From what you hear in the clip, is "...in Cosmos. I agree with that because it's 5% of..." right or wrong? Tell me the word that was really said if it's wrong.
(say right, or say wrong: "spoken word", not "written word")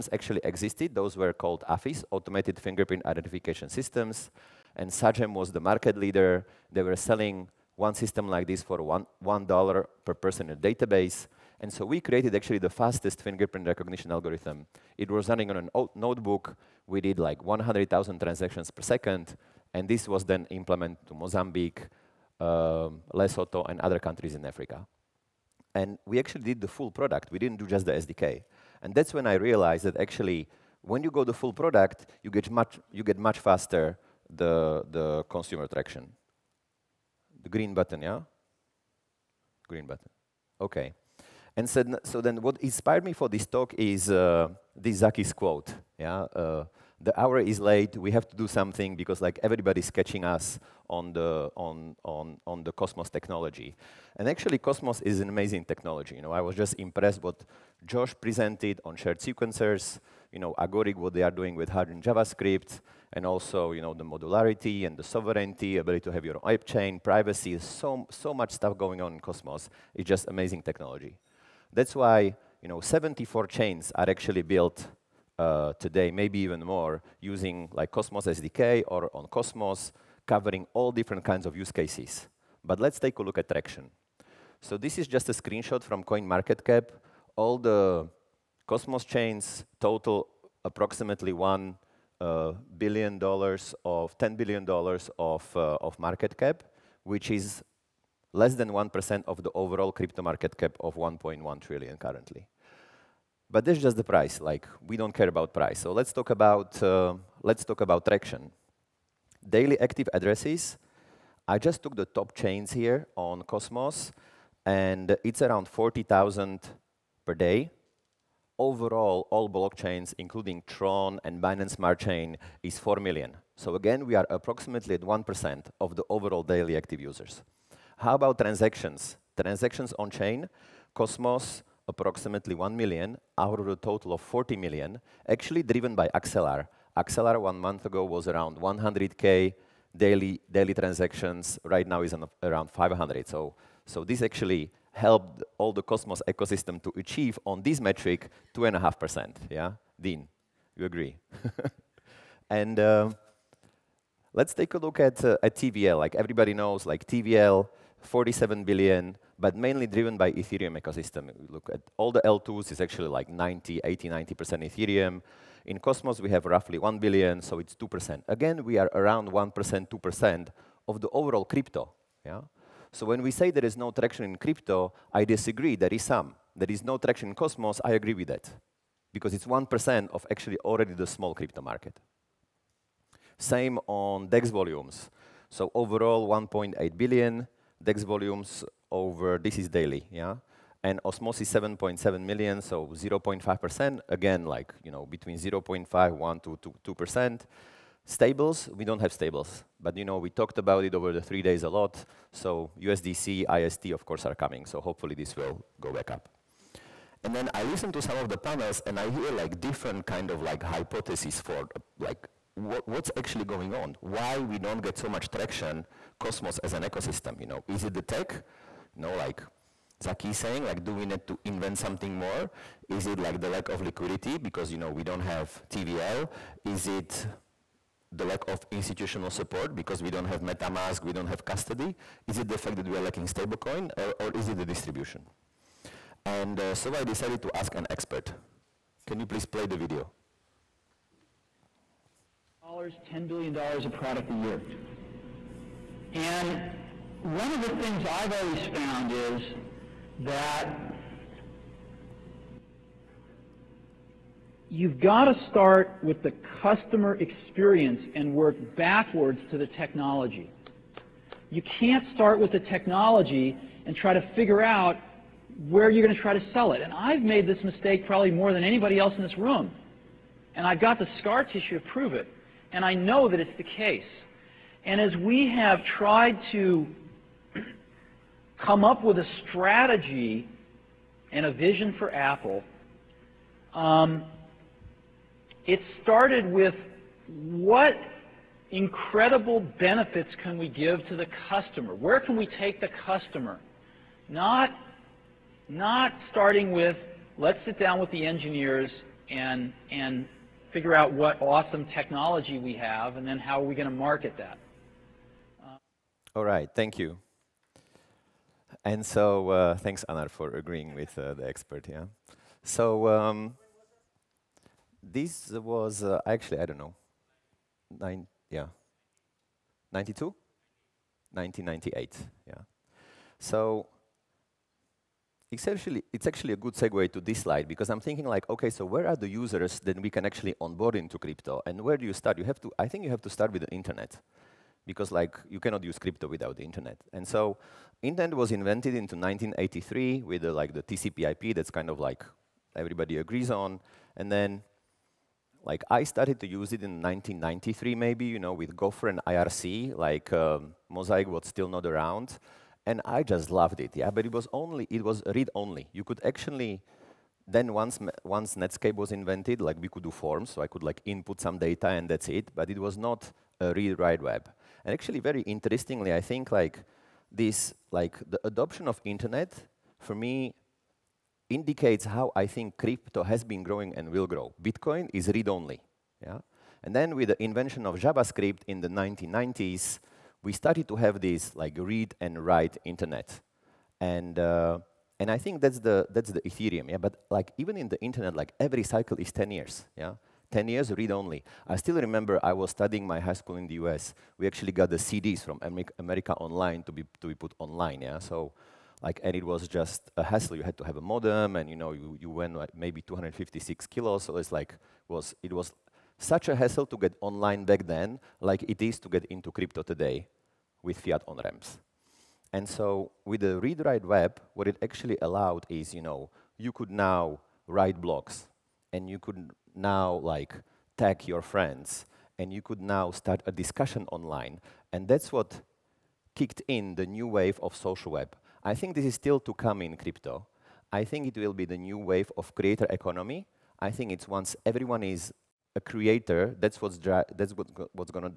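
wrong: "1", not "5".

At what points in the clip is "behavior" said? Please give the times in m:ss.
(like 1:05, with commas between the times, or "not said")
not said.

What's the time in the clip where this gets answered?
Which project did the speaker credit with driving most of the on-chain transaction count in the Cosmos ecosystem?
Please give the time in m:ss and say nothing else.
2:15.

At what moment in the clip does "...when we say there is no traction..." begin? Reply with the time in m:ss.
2:53.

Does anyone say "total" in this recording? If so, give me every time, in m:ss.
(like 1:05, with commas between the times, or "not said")
1:29, 2:13.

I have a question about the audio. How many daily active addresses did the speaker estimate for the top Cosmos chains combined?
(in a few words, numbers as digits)
40,000.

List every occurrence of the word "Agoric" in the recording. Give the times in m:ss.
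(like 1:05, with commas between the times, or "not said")
1:00.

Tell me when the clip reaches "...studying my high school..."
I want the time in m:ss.
6:32.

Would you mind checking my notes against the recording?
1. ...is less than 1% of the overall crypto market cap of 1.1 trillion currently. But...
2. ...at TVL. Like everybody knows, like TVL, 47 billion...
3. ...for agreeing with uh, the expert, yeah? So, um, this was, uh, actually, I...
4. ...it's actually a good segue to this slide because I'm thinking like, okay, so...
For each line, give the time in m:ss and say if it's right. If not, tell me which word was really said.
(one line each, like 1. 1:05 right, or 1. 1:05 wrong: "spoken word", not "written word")
1. 1:37 right
2. 2:35 right
3. 5:10 right
4. 5:26 right.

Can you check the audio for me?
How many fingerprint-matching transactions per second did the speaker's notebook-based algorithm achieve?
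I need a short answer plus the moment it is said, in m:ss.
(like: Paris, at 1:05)
100,000, at 0:17.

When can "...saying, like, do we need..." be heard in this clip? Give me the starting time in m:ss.
3:40.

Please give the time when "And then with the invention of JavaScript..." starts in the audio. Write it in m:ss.
6:16.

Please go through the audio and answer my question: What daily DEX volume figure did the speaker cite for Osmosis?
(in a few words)
7.7 million.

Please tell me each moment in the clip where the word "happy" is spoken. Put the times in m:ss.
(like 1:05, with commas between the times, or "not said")
not said.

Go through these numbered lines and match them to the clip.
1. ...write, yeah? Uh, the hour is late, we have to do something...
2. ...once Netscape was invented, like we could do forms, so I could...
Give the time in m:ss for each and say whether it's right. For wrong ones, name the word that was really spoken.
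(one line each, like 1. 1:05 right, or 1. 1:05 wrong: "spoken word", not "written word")
1. 0:45 wrong: "quote", not "write"
2. 5:58 right.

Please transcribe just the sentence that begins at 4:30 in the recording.
And I've got the scar tissue to prove it.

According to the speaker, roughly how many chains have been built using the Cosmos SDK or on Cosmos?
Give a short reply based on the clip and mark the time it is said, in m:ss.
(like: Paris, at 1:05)
74, at 1:12.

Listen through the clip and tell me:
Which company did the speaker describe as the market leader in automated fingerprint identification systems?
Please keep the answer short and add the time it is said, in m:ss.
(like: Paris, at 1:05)
Sagem, at 0:04.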